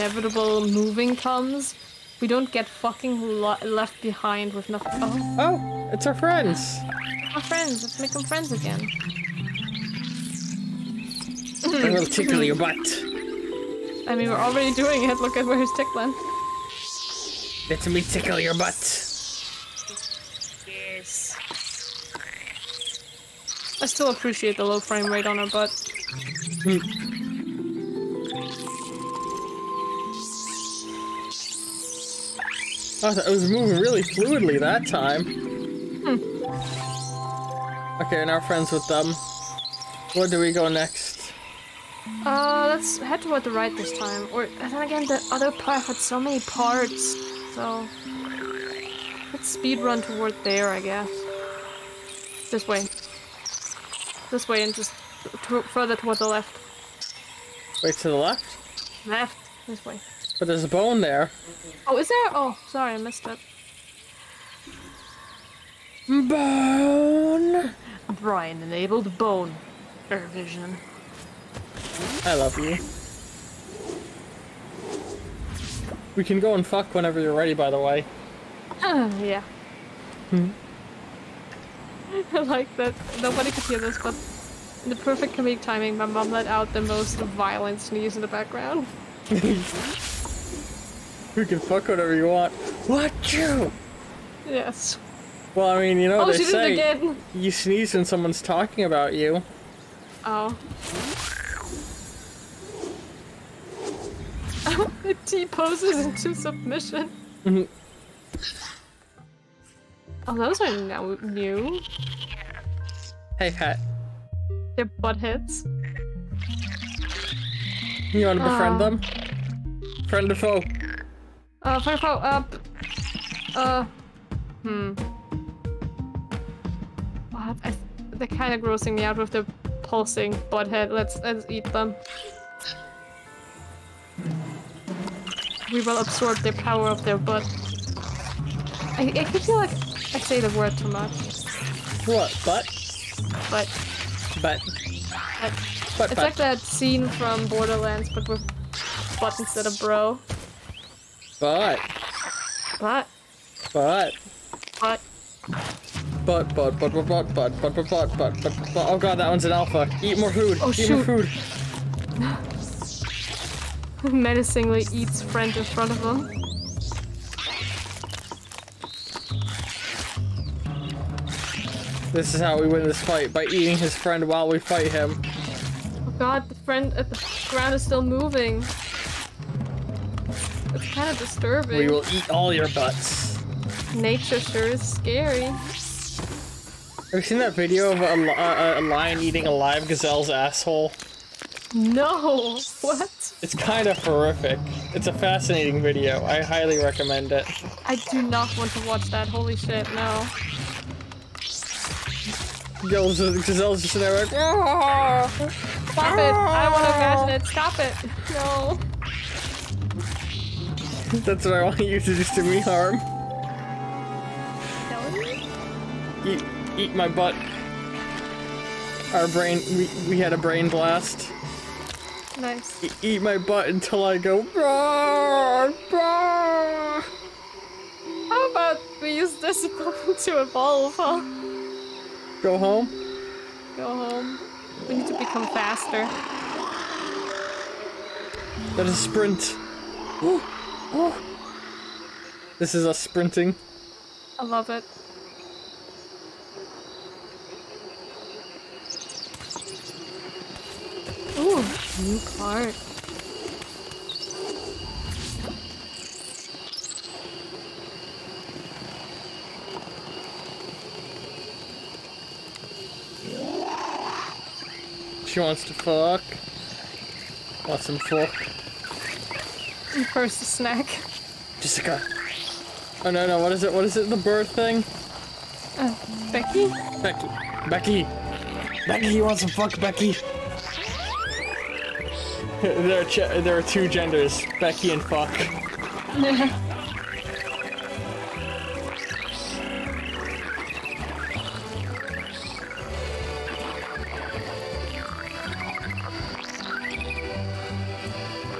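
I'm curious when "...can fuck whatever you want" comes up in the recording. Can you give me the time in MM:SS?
01:31.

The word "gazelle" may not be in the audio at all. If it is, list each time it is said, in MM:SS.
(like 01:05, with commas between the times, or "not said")
03:09, 03:22.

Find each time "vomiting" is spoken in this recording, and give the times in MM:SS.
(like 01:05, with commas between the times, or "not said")
not said.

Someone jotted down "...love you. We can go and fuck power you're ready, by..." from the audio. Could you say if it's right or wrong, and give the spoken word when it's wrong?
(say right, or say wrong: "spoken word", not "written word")
wrong: "whenever", not "power".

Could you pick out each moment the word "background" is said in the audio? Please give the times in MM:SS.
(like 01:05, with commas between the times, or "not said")
01:28.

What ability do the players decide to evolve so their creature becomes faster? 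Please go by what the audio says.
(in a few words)
sprint.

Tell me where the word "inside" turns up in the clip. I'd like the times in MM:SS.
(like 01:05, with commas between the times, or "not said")
not said.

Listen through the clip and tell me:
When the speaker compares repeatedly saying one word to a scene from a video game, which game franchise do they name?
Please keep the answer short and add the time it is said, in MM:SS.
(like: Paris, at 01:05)
Borderlands, at 02:27.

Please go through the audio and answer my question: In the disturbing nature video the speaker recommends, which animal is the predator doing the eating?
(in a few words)
lion.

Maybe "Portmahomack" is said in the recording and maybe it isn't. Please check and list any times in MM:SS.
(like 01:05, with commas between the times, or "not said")
not said.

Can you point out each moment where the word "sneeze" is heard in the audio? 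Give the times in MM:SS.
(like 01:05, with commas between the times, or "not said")
01:27, 01:37.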